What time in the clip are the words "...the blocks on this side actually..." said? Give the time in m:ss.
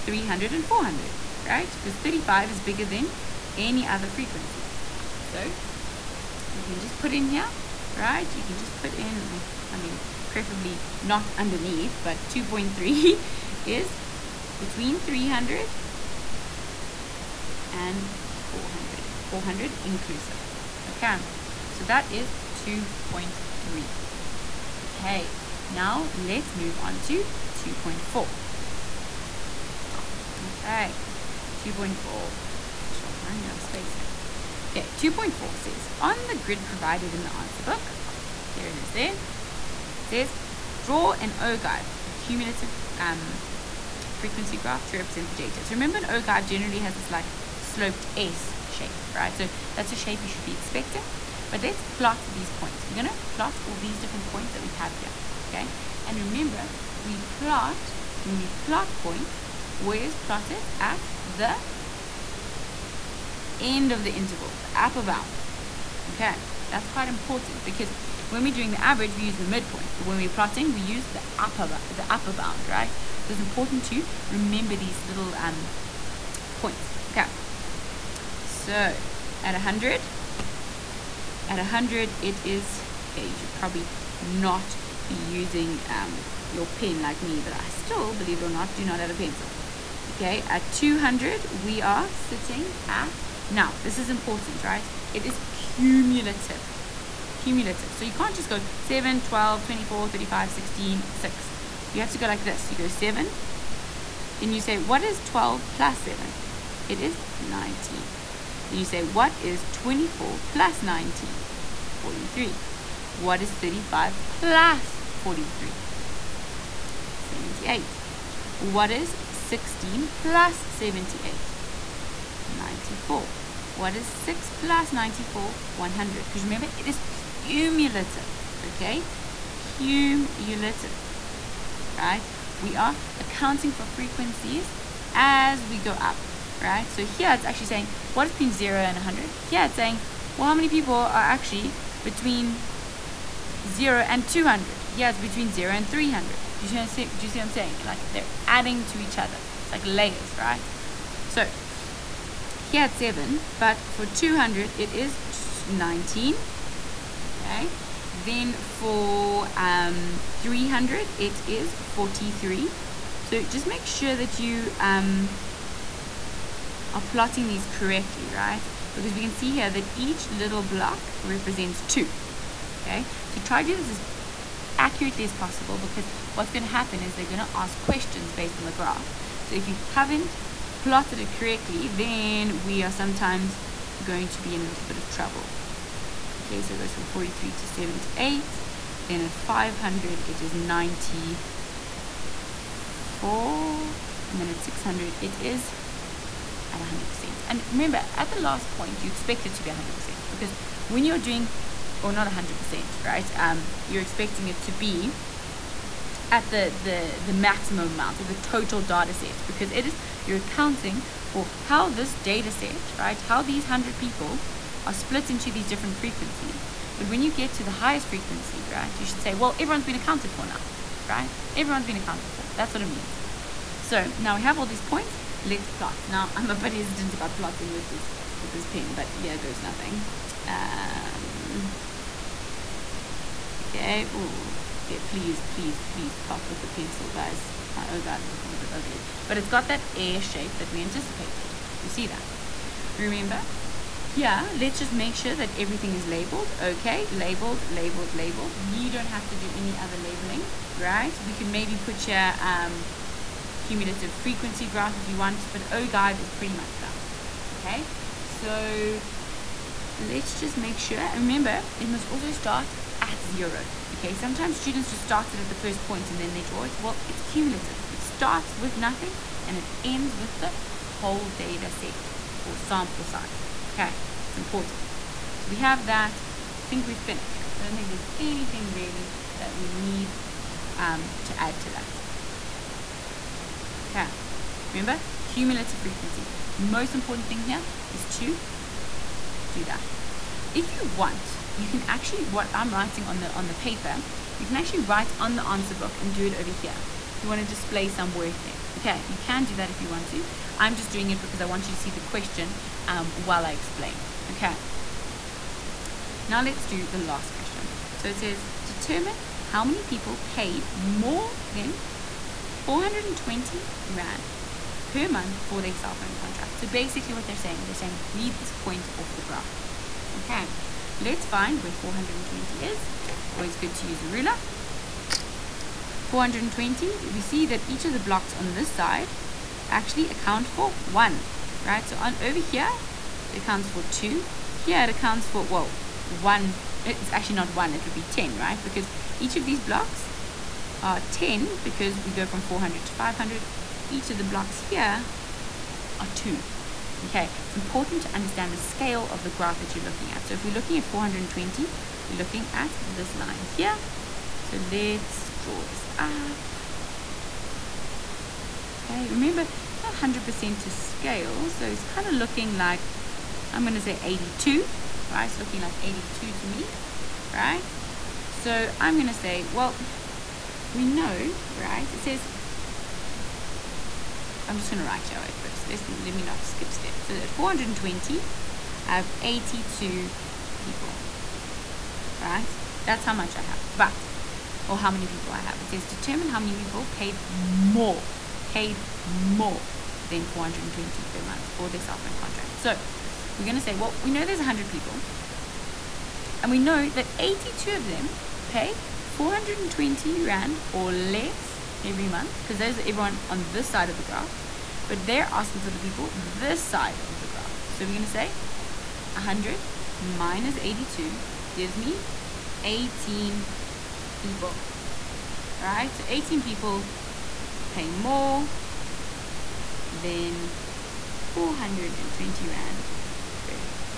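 5:27.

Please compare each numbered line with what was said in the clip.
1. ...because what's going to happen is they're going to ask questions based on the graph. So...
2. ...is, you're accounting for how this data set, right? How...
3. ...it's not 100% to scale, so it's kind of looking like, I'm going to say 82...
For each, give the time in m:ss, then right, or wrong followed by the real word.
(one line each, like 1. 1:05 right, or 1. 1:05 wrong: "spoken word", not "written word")
1. 2:55 right
2. 3:29 right
3. 5:59 right.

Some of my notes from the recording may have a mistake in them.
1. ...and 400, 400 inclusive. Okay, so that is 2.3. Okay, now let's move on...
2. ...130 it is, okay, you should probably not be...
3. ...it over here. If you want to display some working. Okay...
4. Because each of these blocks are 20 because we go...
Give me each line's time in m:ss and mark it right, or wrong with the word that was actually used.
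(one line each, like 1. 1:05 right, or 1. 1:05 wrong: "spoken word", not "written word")
1. 0:17 right
2. 1:21 wrong: "100", not "130"
3. 4:56 right
4. 5:38 wrong: "10", not "20".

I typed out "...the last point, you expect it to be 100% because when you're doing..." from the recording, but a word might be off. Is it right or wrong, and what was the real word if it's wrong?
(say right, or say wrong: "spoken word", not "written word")
right.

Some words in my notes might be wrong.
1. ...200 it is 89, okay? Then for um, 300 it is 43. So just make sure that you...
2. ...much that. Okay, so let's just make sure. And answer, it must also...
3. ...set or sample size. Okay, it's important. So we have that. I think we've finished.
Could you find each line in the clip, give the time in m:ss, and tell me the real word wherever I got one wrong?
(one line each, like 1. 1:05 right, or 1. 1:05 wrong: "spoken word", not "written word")
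1. 2:34 wrong: "19", not "89"
2. 4:16 wrong: "remember", not "answer"
3. 4:31 right.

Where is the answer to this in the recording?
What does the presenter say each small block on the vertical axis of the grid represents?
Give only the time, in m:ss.
2:49.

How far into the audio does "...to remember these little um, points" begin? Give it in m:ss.
1:13.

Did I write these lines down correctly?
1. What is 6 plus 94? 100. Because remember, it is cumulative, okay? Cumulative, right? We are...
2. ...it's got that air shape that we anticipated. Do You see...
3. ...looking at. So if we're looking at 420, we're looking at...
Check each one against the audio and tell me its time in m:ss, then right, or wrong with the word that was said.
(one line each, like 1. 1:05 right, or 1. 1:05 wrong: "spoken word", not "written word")
1. 2:03 right
2. 3:59 right
3. 5:49 right.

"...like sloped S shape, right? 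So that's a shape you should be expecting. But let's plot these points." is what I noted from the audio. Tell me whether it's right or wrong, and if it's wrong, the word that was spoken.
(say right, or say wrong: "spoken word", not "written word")
right.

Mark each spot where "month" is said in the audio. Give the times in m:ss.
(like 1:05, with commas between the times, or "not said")
5:15, 6:31, 6:42.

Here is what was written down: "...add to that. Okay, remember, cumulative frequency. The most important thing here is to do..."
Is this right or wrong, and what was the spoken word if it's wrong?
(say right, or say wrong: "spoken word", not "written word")
right.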